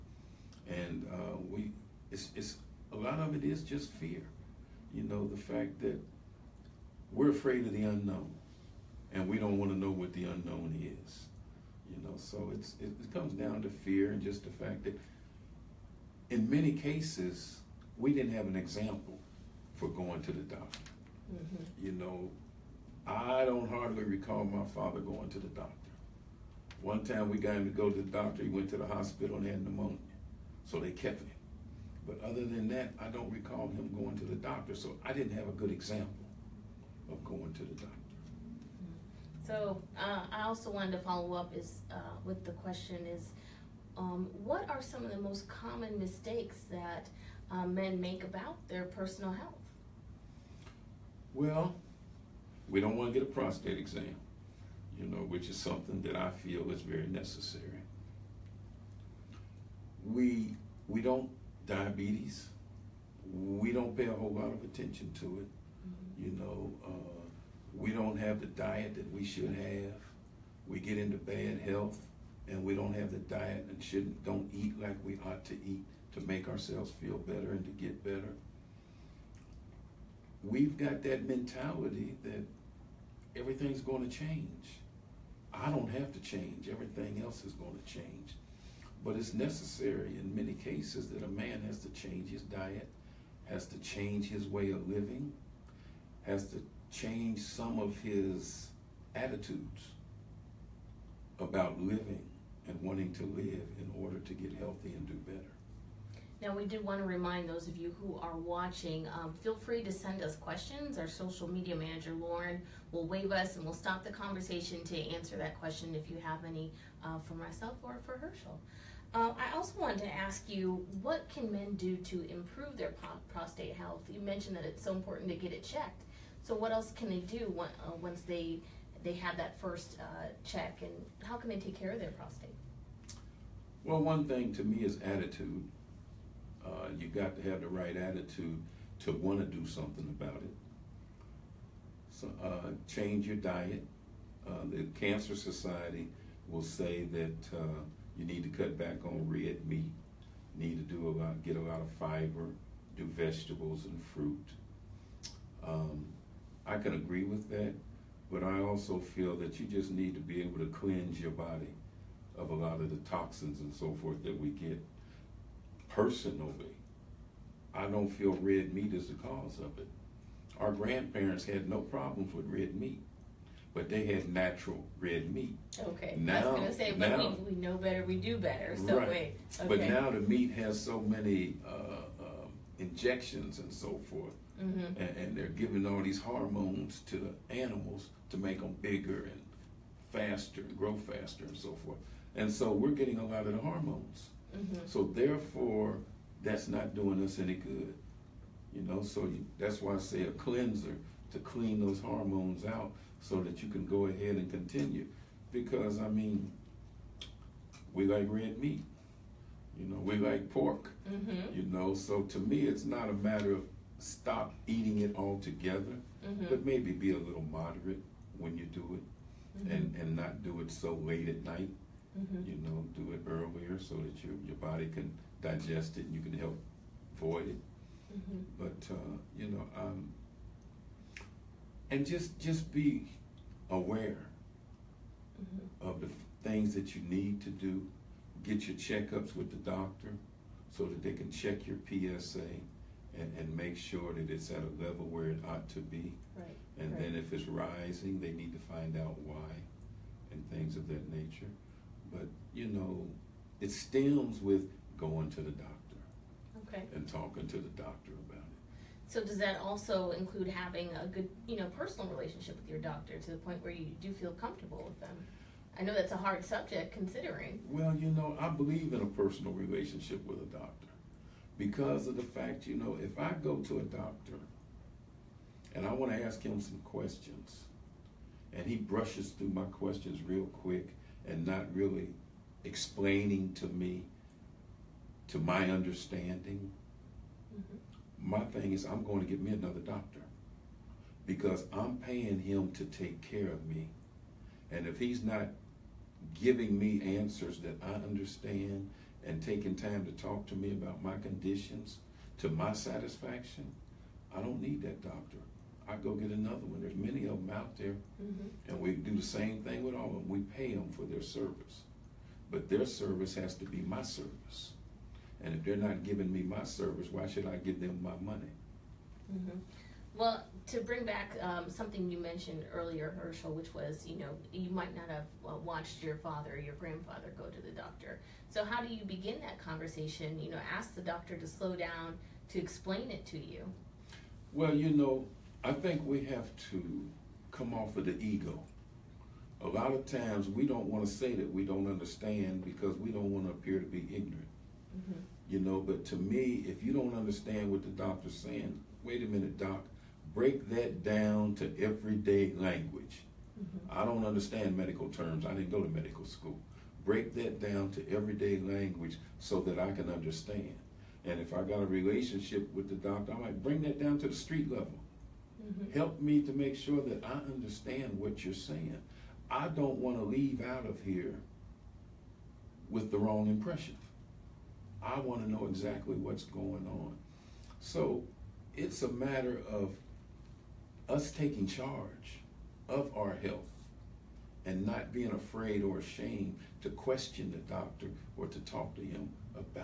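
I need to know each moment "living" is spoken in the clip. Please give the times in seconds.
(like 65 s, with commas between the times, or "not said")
94 s, 101 s.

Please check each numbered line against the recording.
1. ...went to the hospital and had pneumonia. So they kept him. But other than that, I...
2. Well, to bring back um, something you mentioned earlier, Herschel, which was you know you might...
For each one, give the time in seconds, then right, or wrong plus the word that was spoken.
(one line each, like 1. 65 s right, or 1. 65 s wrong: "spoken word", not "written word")
1. 28 s right
2. 320 s right.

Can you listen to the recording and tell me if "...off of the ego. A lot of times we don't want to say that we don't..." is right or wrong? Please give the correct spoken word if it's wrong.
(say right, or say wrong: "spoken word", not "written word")
right.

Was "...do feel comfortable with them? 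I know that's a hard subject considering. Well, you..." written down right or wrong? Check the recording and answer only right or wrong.
right.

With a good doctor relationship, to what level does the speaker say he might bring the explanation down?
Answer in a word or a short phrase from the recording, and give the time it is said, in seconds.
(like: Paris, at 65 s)
street level, at 364 s.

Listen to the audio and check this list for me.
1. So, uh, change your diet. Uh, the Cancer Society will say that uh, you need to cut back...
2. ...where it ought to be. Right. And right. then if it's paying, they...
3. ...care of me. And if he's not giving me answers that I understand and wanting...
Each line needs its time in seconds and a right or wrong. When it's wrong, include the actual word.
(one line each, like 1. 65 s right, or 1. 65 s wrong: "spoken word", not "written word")
1. 142 s right
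2. 245 s wrong: "rising", not "paying"
3. 293 s wrong: "taking", not "wanting".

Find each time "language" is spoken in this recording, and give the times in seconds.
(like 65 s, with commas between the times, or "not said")
352 s, 358 s.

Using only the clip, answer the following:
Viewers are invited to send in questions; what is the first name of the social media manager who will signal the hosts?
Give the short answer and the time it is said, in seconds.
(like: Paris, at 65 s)
Lauren, at 112 s.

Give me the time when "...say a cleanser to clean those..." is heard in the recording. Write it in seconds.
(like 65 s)
199 s.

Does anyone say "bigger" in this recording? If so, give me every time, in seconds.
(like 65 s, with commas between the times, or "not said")
188 s.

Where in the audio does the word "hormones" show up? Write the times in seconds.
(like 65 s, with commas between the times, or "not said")
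186 s, 193 s, 201 s.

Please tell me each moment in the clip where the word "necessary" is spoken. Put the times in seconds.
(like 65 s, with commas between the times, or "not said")
57 s, 89 s.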